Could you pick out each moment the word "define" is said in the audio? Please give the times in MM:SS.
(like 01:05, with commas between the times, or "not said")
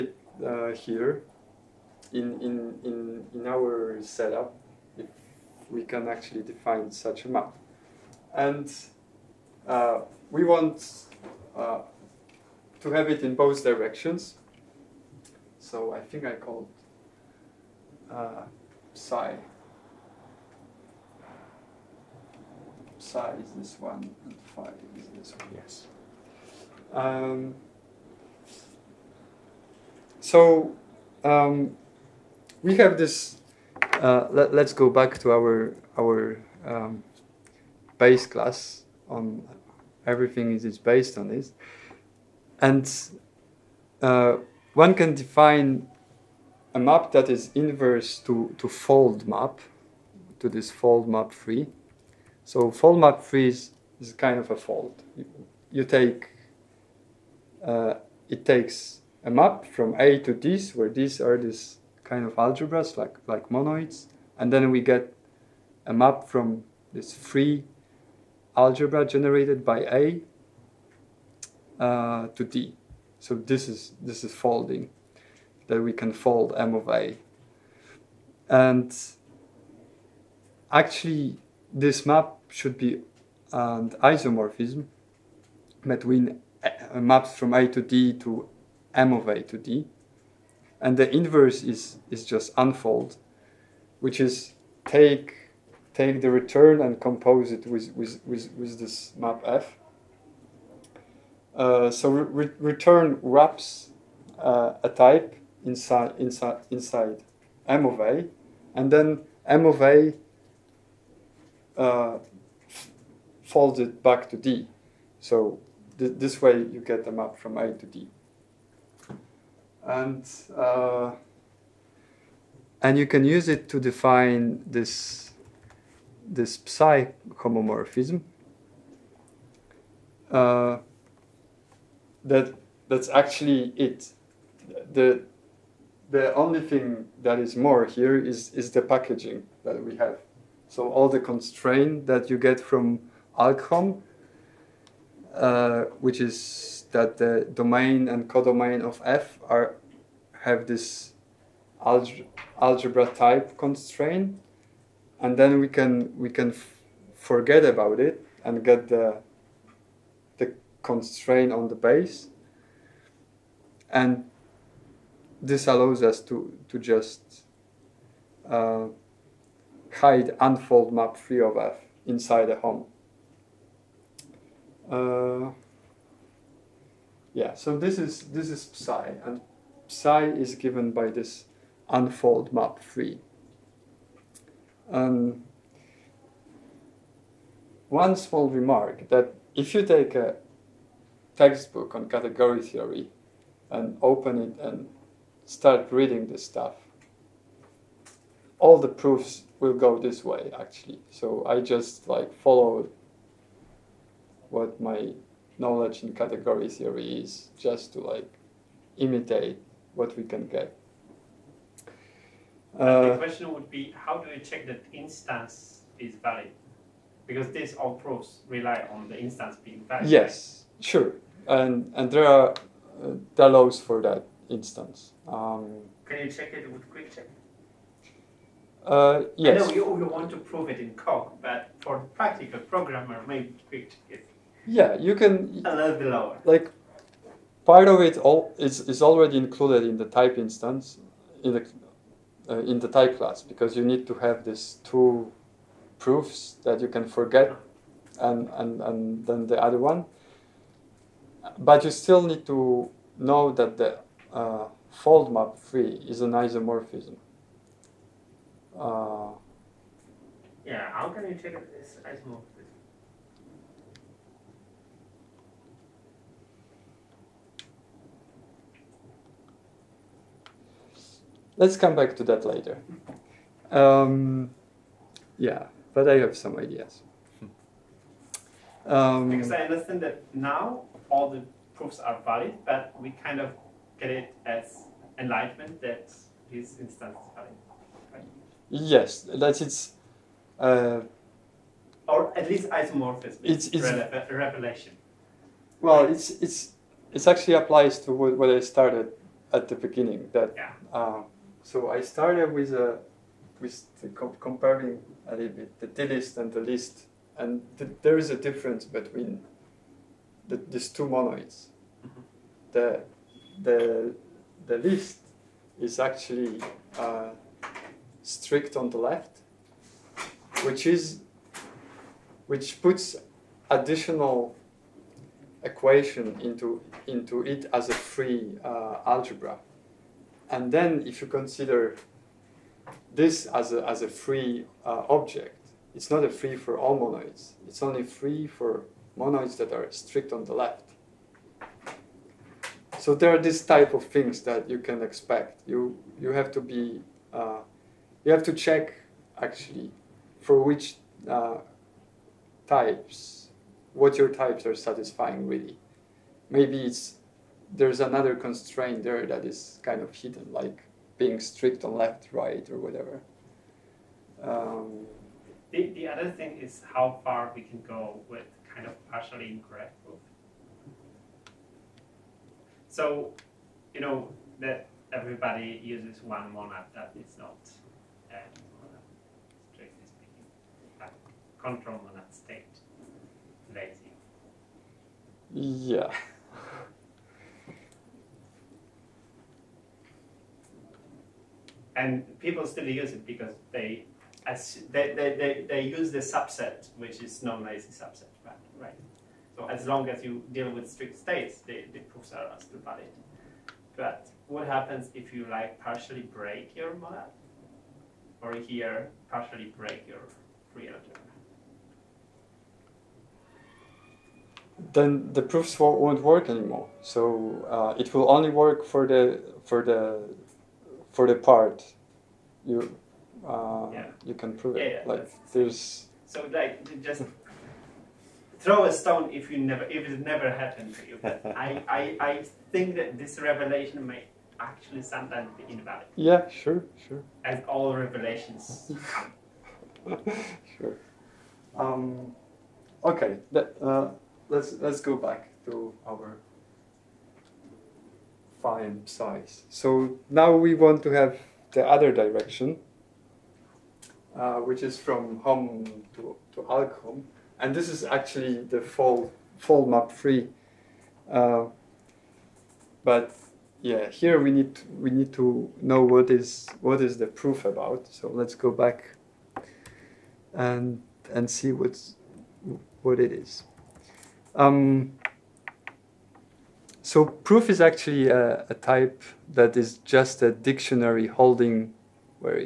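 00:06, 00:45, 02:03.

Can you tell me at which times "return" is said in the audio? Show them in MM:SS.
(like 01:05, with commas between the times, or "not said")
01:36, 01:42.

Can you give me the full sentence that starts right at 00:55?
You, you take uh, it takes a map from A to this, where these are this kind of algebras like, like monoids.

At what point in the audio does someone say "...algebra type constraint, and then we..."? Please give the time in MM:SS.
02:32.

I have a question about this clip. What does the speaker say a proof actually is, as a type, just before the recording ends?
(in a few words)
a dictionary.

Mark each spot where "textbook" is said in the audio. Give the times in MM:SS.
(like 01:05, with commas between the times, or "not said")
03:11.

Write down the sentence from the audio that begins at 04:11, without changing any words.
But you still need to know that the uh, fold map free is an isomorphism.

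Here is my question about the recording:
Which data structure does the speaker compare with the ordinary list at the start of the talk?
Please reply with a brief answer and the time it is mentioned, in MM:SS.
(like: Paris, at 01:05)
DList, at 05:05.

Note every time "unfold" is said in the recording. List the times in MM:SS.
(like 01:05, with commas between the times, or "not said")
01:32, 02:50, 03:01.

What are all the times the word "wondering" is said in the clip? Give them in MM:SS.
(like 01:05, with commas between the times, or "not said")
not said.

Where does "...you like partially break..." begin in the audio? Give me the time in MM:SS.
06:45.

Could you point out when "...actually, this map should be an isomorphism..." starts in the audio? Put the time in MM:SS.
01:20.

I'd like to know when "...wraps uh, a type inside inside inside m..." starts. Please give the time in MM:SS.
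01:43.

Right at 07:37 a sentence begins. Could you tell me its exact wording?
And this is actually the full full map free.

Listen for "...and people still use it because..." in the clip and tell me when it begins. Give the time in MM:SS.
06:31.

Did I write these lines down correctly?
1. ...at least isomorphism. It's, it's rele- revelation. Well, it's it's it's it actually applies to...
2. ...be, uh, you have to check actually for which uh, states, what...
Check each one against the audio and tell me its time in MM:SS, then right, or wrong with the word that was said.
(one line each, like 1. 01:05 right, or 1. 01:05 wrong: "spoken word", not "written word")
1. 04:52 right
2. 05:46 wrong: "types", not "states".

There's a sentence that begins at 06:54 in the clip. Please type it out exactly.
Then the proofs won't work anymore.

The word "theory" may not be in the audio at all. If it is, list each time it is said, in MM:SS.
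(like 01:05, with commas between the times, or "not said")
03:12, 03:26.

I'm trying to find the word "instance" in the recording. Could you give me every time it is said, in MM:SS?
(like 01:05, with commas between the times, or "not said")
03:34, 03:39, 03:44, 04:00, 04:46.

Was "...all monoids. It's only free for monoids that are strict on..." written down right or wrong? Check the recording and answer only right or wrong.
right.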